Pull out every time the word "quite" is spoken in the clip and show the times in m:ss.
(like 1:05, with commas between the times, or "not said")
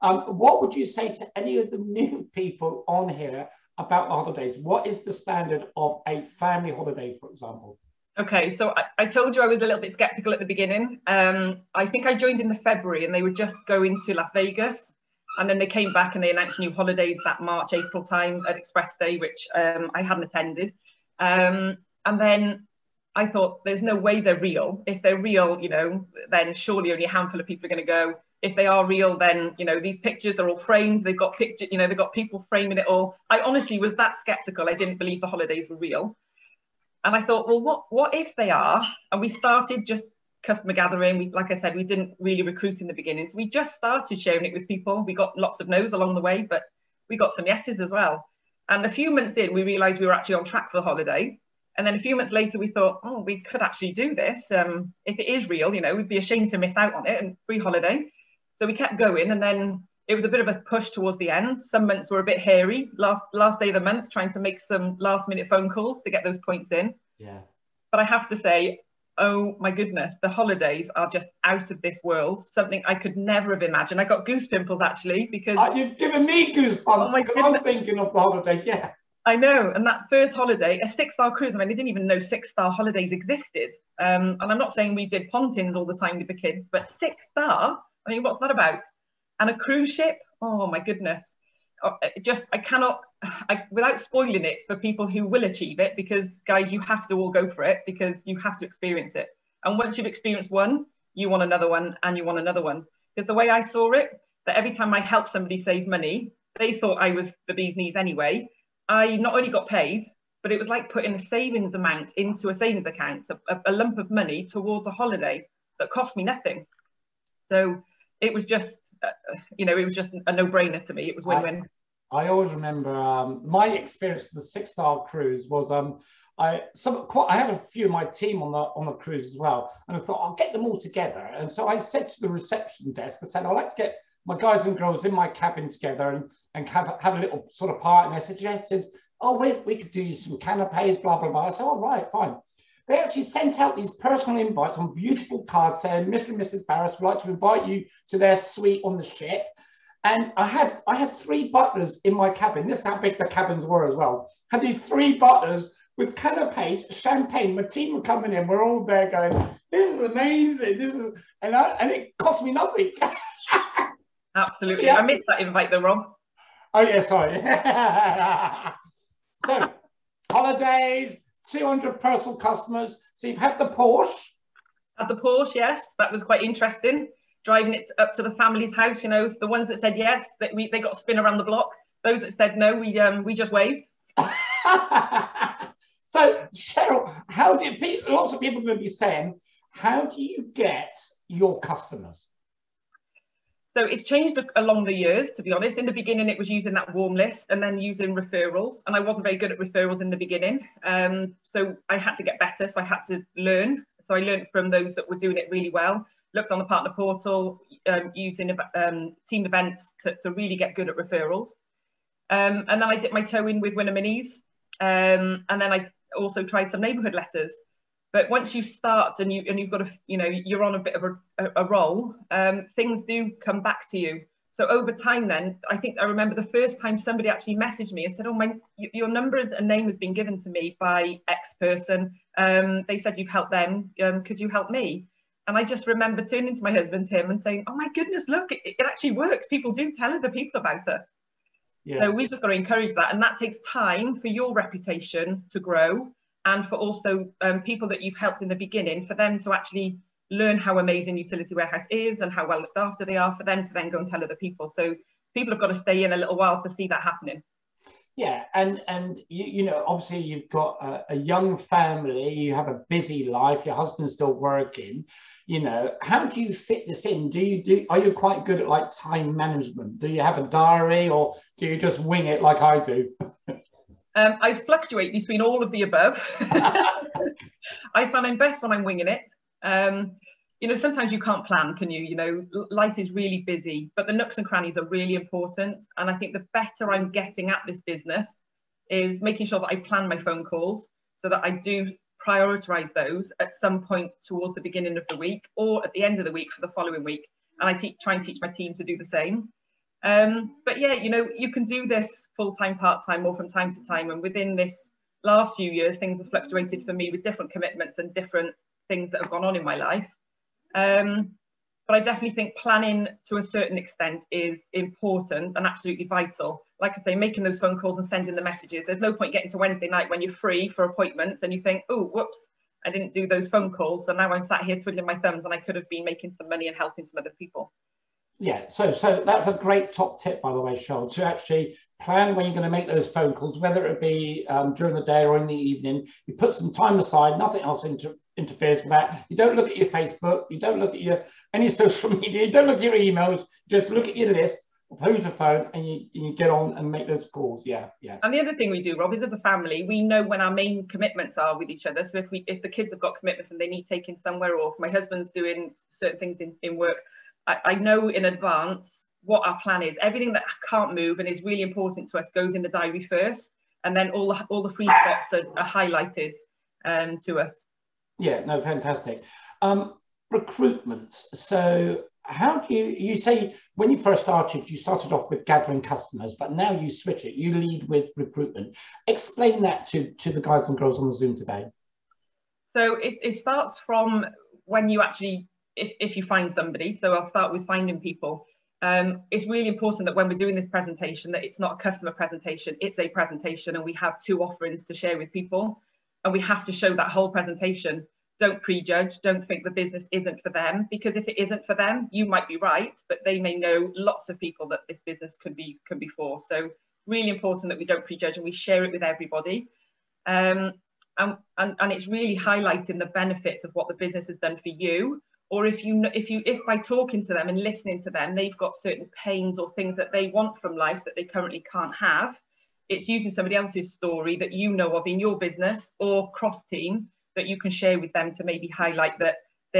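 2:07, 2:56, 4:28.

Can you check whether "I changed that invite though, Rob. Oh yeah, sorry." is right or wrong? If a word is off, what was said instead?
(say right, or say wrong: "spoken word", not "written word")
wrong: "missed", not "changed".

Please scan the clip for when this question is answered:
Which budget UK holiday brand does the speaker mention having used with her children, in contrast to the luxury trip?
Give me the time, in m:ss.
1:25.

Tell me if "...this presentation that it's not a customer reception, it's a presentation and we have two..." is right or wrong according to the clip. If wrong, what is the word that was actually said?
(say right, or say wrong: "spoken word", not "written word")
wrong: "presentation", not "reception".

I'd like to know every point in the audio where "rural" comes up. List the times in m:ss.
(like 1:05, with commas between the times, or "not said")
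not said.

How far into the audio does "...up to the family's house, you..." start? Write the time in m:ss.
2:57.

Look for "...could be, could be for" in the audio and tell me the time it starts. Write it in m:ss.
6:45.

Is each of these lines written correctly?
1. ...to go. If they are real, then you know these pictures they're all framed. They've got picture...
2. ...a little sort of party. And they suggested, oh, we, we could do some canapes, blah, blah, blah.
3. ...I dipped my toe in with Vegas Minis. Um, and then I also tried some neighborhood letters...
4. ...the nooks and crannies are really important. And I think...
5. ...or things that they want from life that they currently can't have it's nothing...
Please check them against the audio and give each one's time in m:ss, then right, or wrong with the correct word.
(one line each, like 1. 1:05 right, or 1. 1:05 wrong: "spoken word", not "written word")
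1. 0:27 right
2. 2:17 right
3. 3:32 wrong: "Winning", not "Vegas"
4. 4:44 right
5. 6:59 wrong: "using", not "nothing".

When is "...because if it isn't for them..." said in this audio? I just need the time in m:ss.
6:40.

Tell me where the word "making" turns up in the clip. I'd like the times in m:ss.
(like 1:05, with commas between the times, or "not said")
4:49, 5:17, 5:26.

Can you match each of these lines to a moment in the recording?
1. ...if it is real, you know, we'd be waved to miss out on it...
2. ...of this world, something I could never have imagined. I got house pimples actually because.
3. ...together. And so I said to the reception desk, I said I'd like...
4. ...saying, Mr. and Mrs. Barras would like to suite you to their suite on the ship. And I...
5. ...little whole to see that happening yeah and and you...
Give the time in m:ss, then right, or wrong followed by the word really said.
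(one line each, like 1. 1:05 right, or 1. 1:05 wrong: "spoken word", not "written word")
1. 0:55 wrong: "ashamed", not "waved"
2. 1:11 wrong: "goose", not "house"
3. 2:10 right
4. 2:25 wrong: "invite", not "suite"
5. 4:16 wrong: "while", not "whole".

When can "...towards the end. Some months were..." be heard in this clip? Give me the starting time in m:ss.
1:00.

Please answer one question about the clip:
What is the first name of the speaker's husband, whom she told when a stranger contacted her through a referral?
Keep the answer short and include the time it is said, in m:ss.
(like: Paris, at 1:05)
Tim, at 3:57.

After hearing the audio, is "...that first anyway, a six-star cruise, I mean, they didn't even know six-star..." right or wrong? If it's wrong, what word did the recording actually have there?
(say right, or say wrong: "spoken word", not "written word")
wrong: "holiday", not "anyway".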